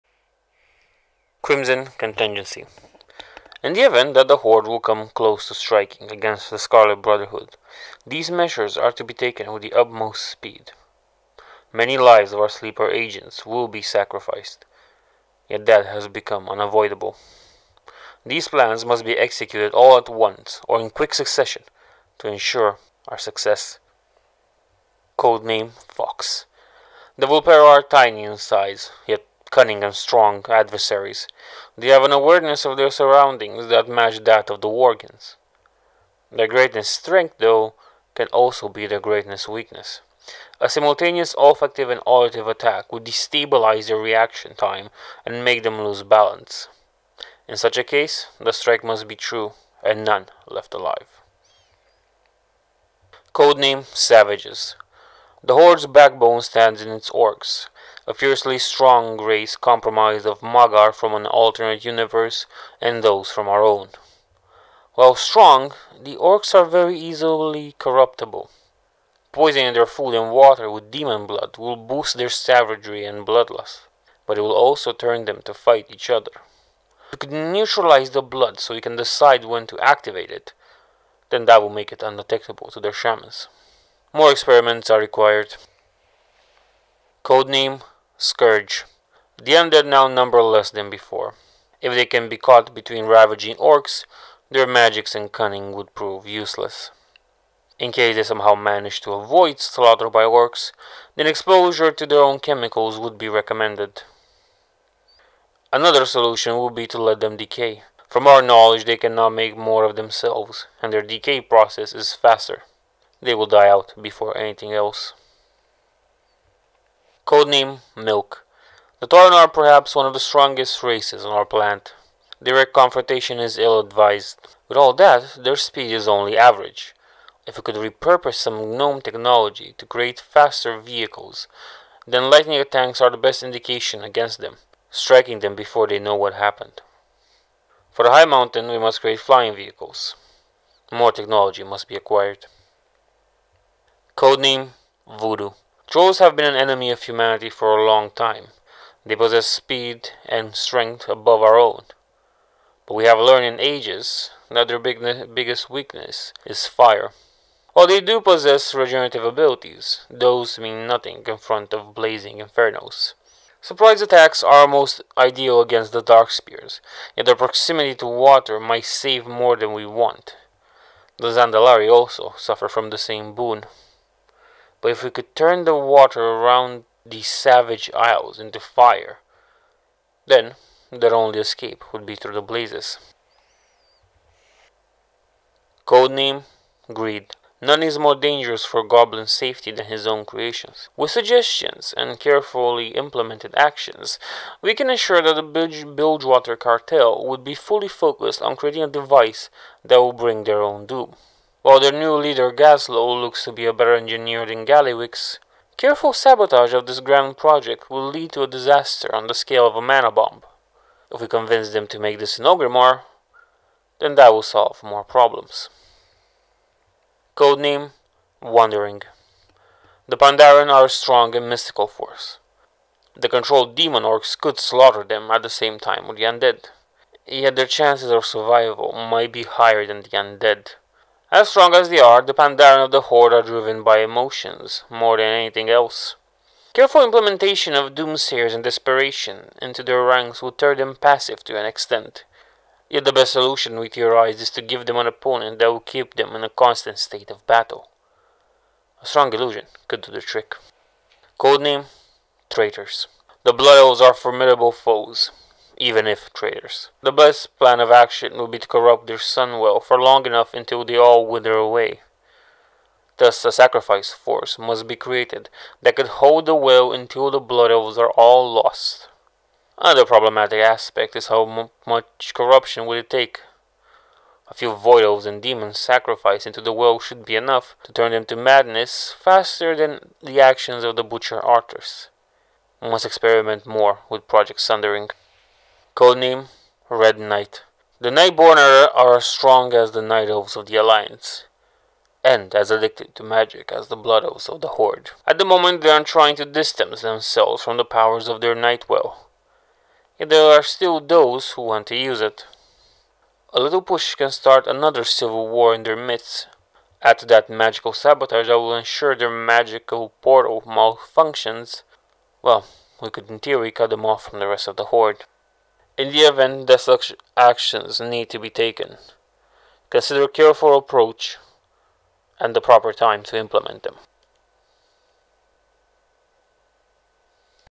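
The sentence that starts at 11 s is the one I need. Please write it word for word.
Many lives of our sleeper agents will be sacrificed, yet that has become unavoidable.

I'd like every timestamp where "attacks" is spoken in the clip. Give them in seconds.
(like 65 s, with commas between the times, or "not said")
42 s, 132 s, 164 s.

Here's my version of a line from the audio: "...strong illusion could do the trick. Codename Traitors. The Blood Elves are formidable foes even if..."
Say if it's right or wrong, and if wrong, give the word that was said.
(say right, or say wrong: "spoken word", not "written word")
right.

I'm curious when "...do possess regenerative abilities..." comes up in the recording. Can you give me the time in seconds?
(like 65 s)
157 s.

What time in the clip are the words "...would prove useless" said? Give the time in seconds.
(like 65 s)
95 s.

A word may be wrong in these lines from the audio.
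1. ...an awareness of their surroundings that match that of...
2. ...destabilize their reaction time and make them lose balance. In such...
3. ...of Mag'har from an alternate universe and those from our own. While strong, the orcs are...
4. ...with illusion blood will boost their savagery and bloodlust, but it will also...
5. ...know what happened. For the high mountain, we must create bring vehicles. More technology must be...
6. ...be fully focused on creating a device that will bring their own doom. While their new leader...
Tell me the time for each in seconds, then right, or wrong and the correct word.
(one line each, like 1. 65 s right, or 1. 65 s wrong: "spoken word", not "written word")
1. 32 s right
2. 43 s right
3. 60 s right
4. 70 s wrong: "demon", not "illusion"
5. 135 s wrong: "flying", not "bring"
6. 197 s right.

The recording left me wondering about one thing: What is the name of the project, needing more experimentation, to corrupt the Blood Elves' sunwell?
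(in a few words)
Project Sundering.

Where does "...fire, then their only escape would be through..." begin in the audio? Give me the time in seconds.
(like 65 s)
178 s.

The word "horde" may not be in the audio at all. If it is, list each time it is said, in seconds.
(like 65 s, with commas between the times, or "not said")
4 s, 55 s, 233 s, 294 s, 314 s.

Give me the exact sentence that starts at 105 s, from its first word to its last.
Another solution would be to let them decay.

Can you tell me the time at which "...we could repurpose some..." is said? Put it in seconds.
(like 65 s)
127 s.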